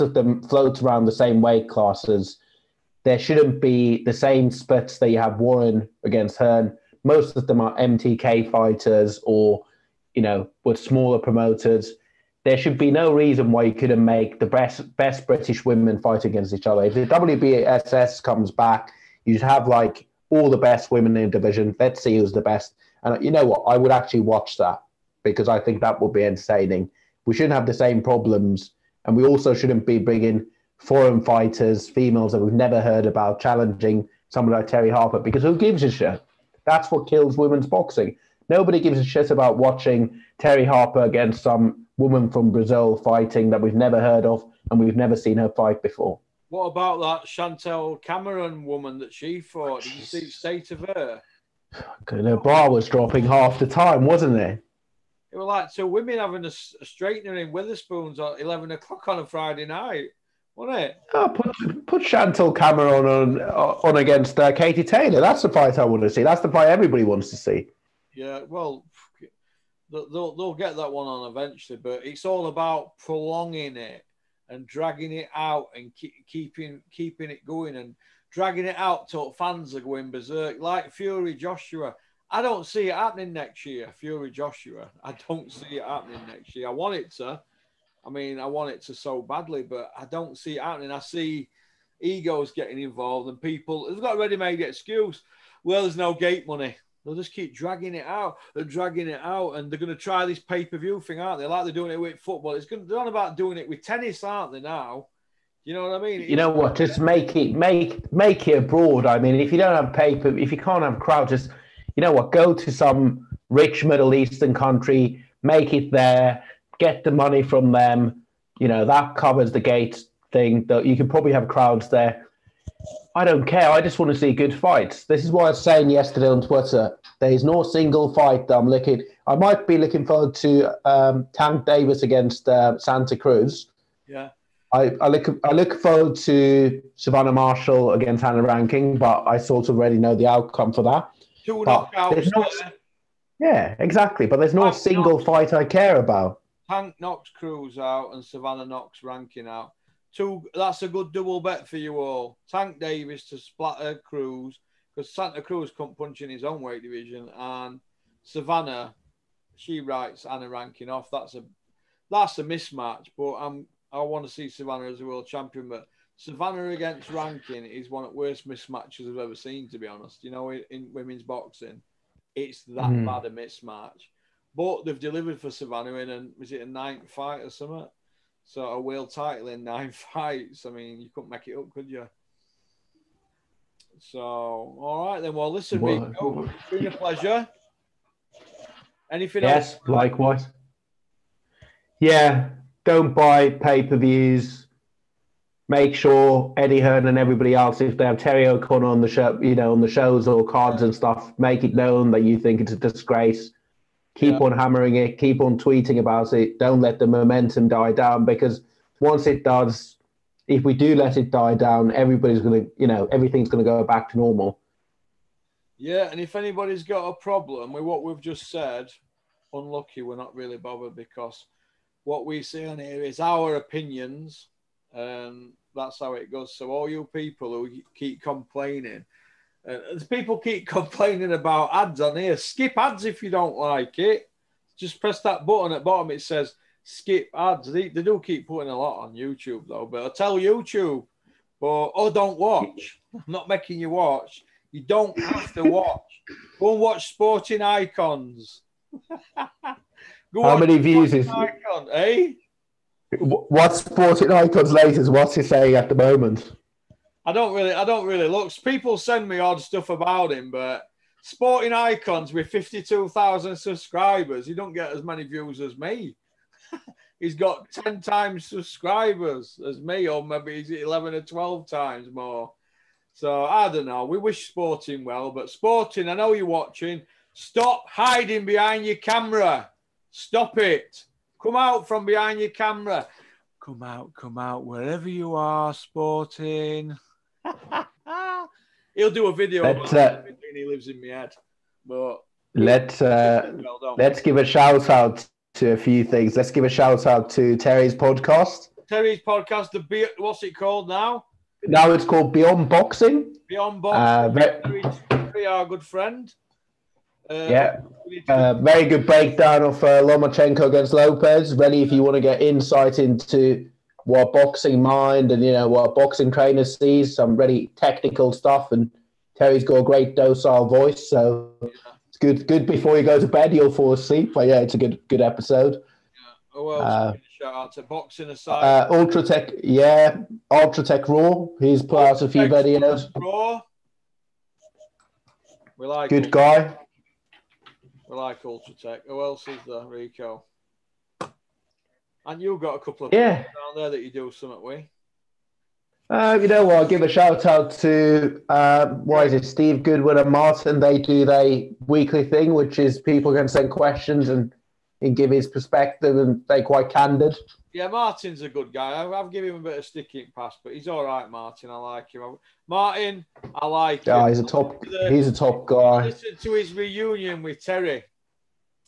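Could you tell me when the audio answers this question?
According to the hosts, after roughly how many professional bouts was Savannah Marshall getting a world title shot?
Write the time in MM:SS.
02:59.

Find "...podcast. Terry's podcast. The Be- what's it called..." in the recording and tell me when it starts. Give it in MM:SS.
04:57.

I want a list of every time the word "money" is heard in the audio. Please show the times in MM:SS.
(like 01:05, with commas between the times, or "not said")
01:36, 01:57.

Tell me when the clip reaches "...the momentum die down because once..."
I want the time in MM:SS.
03:26.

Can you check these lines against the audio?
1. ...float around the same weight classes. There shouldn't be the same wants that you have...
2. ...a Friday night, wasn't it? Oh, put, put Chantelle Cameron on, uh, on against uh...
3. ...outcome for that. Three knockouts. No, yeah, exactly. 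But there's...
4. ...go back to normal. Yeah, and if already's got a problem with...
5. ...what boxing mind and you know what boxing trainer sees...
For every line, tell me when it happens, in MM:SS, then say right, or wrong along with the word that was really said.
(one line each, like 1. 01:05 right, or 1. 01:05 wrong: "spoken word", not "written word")
1. 00:00 wrong: "splits", not "wants"
2. 00:59 right
3. 02:20 wrong: "Two", not "Three"
4. 03:33 wrong: "anybody", not "already"
5. 05:14 right.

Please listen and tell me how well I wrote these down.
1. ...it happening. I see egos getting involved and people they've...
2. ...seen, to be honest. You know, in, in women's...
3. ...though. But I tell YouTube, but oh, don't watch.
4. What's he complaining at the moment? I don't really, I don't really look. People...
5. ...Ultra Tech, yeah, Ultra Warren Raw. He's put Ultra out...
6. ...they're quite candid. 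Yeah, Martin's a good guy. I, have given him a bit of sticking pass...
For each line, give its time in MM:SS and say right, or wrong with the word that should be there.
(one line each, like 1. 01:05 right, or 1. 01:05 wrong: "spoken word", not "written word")
1. 01:30 right
2. 02:49 right
3. 03:59 right
4. 04:15 wrong: "saying", not "complaining"
5. 05:28 wrong: "Tech", not "Warren"
6. 05:56 right.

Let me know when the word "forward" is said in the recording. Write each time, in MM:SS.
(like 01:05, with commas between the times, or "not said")
02:10, 02:15.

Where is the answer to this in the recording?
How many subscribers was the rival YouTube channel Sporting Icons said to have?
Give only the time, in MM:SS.
04:22.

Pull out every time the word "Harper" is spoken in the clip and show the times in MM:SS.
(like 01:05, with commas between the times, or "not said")
00:34, 00:40.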